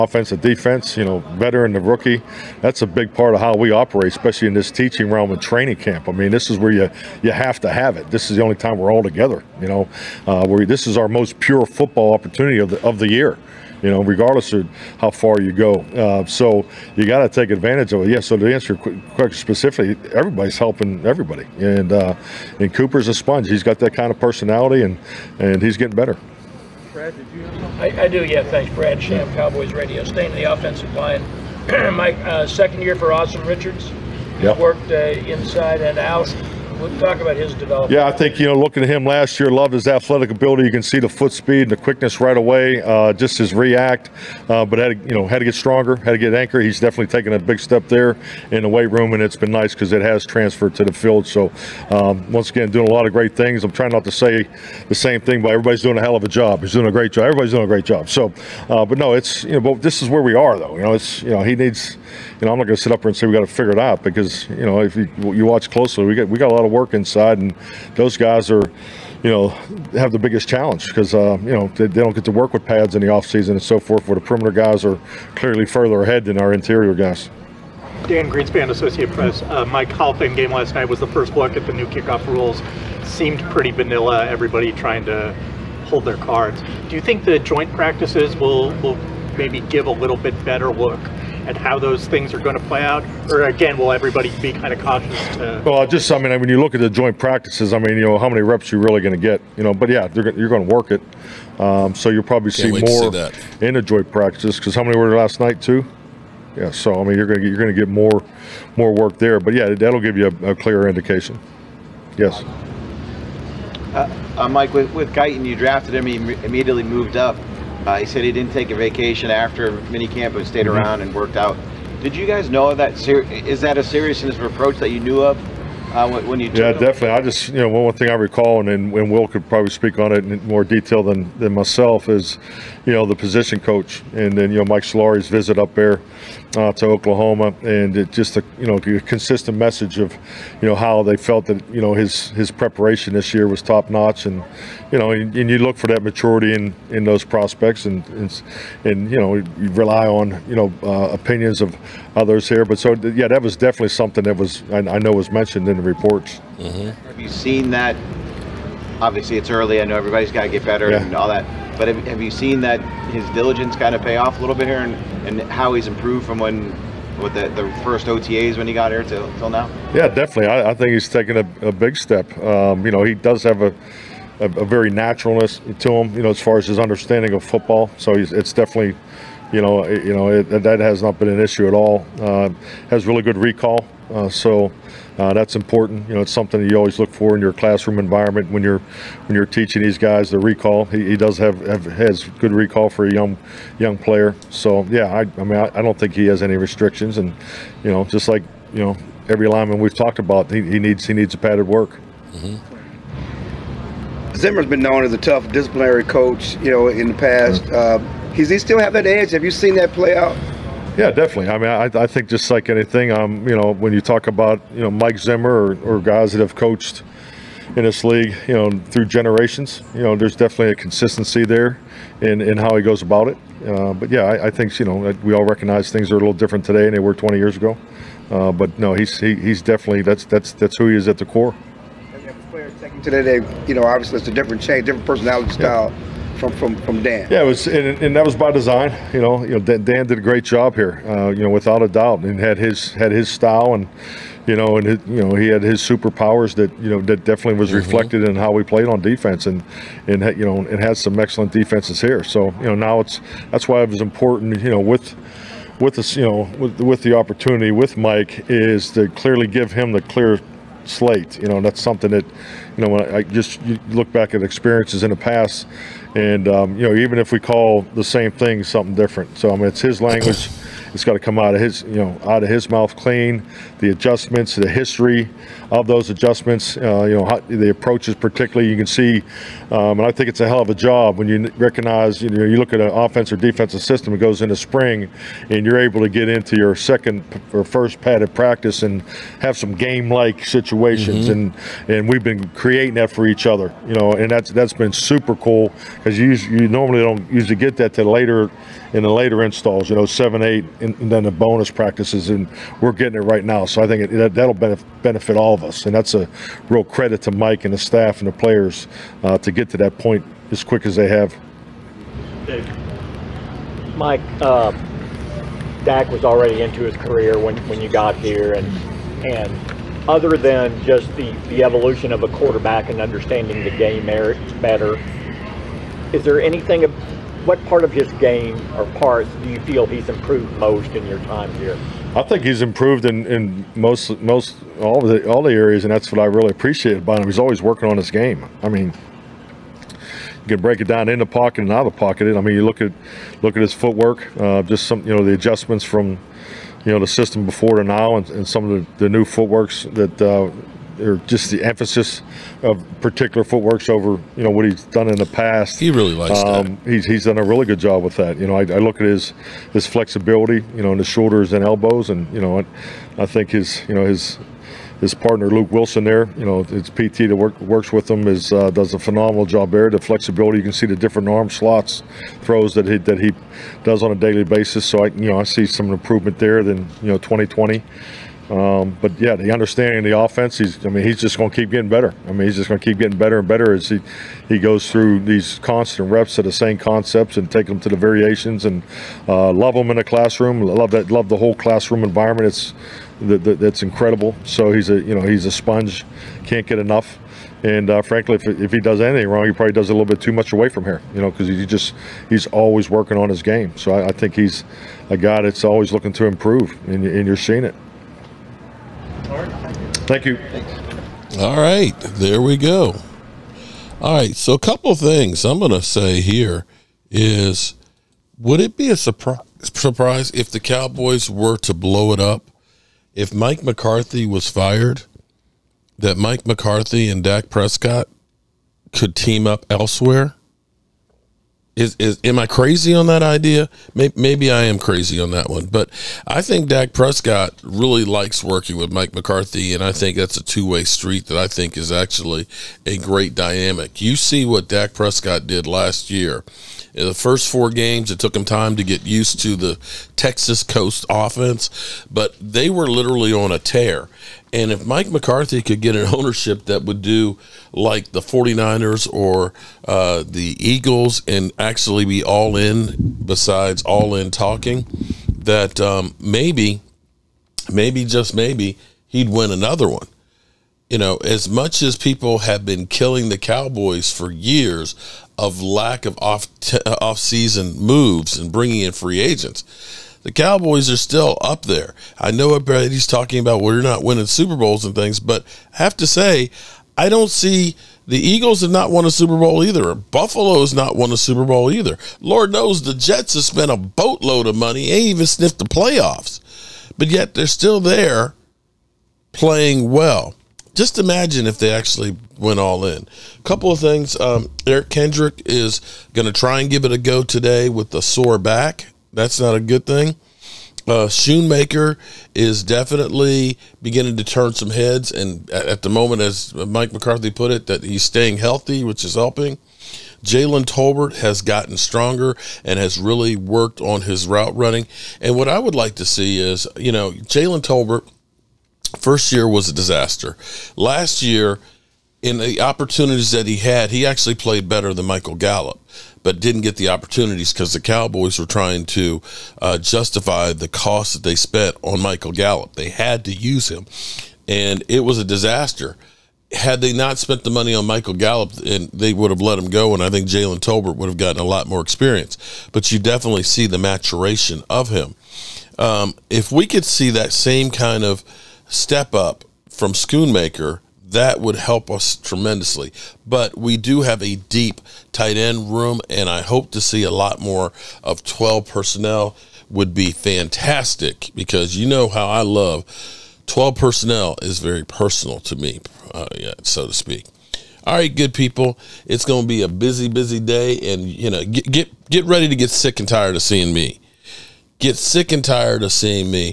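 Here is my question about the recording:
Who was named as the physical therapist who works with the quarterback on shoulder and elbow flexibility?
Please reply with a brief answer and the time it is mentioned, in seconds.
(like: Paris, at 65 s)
Luke Wilson, at 365 s.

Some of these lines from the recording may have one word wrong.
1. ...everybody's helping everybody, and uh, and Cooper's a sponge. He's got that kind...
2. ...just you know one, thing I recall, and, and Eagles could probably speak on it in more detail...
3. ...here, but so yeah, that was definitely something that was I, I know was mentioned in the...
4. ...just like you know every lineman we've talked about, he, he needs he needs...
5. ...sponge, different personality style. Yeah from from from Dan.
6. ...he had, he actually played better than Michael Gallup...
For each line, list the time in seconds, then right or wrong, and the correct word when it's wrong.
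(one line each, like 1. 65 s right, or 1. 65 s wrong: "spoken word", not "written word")
1. 20 s right
2. 127 s wrong: "Will", not "Eagles"
3. 152 s right
4. 198 s right
5. 234 s wrong: "change", not "sponge"
6. 533 s right.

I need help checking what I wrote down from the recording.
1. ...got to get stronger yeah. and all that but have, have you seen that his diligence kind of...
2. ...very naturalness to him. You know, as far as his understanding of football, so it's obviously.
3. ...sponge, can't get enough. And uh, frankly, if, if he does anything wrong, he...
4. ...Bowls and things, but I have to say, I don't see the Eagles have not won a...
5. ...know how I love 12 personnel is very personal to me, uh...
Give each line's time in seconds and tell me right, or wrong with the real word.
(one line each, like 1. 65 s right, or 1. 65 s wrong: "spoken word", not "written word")
1. 160 s wrong: "better", not "stronger"
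2. 174 s wrong: "definitely", not "obviously"
3. 395 s right
4. 484 s right
5. 571 s right.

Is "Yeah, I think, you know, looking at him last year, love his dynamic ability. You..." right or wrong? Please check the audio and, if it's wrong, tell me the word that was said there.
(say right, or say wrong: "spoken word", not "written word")
wrong: "athletic", not "dynamic".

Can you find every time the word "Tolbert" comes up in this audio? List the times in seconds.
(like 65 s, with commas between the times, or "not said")
520 s, 527 s, 550 s.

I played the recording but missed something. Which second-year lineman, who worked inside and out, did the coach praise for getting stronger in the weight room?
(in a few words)
Austin Richards.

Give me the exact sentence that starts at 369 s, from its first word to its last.
The flexibility you can see the different arm slots, throws that he that he does on a daily basis.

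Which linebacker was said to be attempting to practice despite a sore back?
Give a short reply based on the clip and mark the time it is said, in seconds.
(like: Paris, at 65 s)
Eric Kendrick, at 504 s.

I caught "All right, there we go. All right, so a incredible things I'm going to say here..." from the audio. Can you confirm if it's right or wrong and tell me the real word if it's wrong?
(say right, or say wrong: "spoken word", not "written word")
wrong: "couple", not "incredible".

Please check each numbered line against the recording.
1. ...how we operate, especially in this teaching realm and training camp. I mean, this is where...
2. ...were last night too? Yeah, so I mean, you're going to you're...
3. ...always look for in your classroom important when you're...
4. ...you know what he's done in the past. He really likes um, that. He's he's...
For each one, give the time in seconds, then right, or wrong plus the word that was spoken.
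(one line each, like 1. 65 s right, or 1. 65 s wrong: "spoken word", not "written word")
1. 3 s right
2. 104 s right
3. 186 s wrong: "environment", not "important"
4. 354 s right.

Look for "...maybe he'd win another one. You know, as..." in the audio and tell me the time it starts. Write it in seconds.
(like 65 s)
468 s.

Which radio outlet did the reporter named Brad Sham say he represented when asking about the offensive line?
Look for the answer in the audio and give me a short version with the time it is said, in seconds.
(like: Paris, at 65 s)
Cowboys Radio, at 29 s.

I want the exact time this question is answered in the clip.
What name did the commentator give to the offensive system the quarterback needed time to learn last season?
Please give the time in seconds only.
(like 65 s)
450 s.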